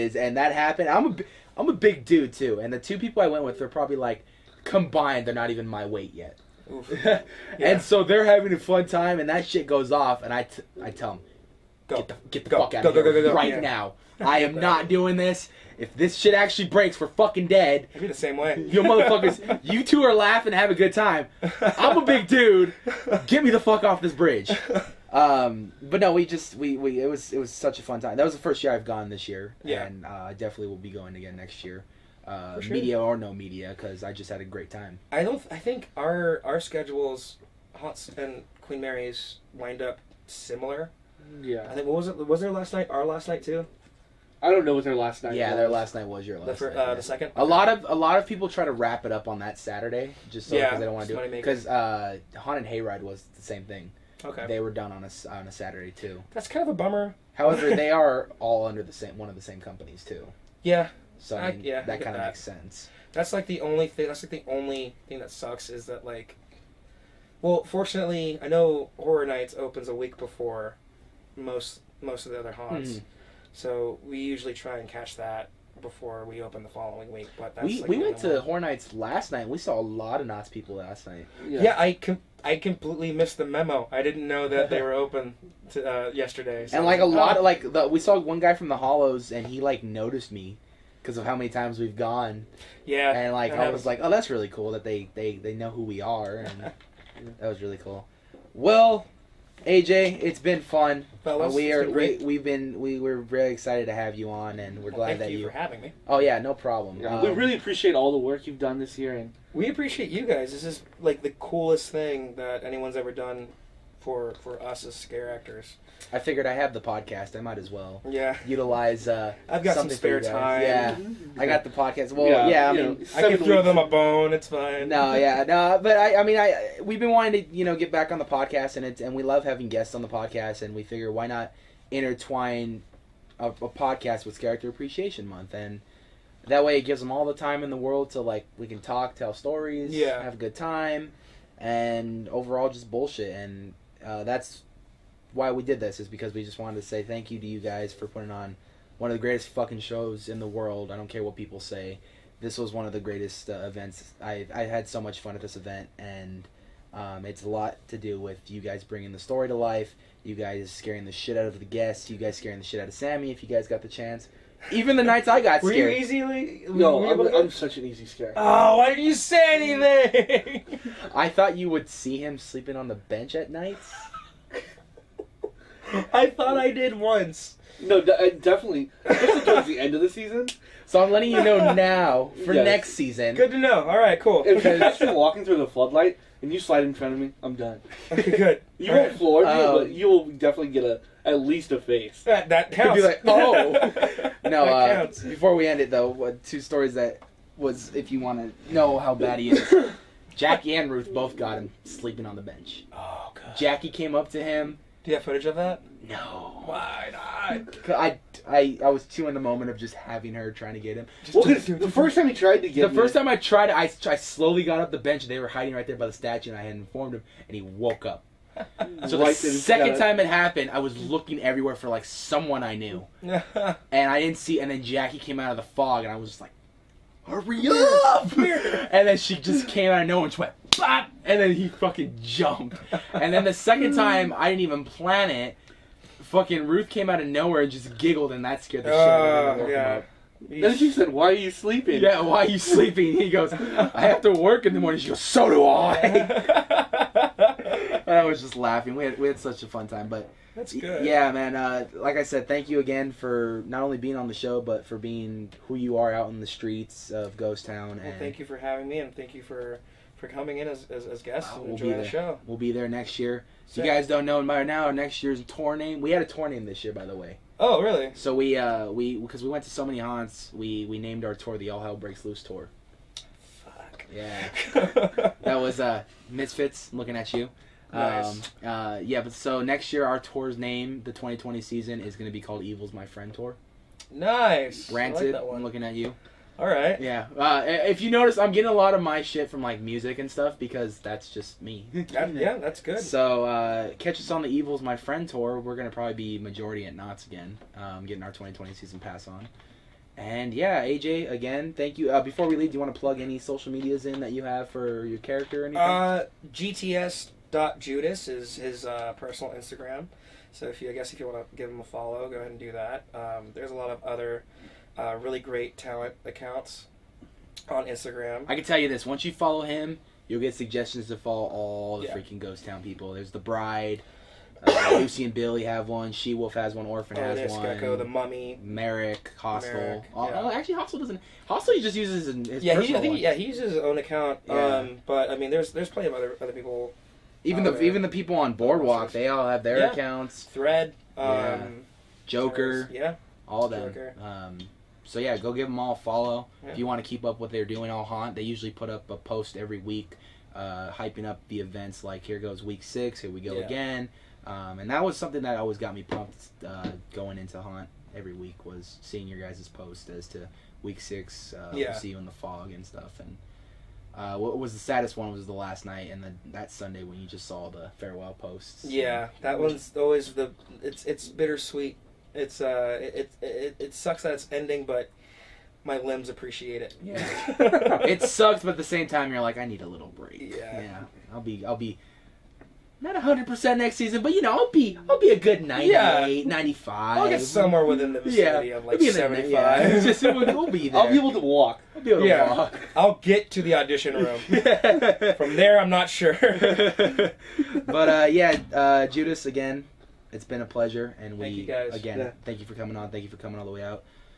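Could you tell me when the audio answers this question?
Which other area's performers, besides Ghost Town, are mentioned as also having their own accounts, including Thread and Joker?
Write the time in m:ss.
5:38.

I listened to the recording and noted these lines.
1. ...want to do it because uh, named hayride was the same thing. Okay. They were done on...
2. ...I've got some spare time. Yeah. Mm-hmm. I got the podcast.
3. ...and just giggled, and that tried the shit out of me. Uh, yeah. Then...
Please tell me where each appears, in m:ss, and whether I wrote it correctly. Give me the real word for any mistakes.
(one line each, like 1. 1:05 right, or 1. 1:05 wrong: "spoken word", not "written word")
1. 0:50 wrong: "haunted", not "named"
2. 1:59 right
3. 3:57 wrong: "scared", not "tried".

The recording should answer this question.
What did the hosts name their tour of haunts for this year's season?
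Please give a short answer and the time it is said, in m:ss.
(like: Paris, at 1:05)
All Hell Breaks Loose, at 4:31.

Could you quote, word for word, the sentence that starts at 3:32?
first time I tried, I, I slowly got up the bench.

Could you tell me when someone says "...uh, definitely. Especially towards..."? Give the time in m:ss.
2:57.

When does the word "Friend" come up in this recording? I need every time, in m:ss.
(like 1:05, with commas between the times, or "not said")
4:43, 4:54.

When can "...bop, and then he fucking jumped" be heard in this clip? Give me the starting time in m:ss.
3:50.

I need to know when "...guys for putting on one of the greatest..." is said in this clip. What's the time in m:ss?
2:27.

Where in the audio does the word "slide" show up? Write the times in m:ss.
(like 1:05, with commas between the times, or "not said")
3:06.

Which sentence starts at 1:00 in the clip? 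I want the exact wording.
Yeah, so I mean, yeah, that kind of makes sense.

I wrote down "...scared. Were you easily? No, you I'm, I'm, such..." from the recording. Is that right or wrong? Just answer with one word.
right.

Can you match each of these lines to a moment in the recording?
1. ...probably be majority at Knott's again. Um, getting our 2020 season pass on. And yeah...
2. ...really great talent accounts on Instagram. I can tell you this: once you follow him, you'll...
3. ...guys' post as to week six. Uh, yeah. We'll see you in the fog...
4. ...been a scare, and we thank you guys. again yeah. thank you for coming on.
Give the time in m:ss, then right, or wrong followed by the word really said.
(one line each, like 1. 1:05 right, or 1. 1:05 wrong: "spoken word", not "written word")
1. 4:55 right
2. 5:15 right
3. 5:59 right
4. 6:40 wrong: "pleasure", not "scare".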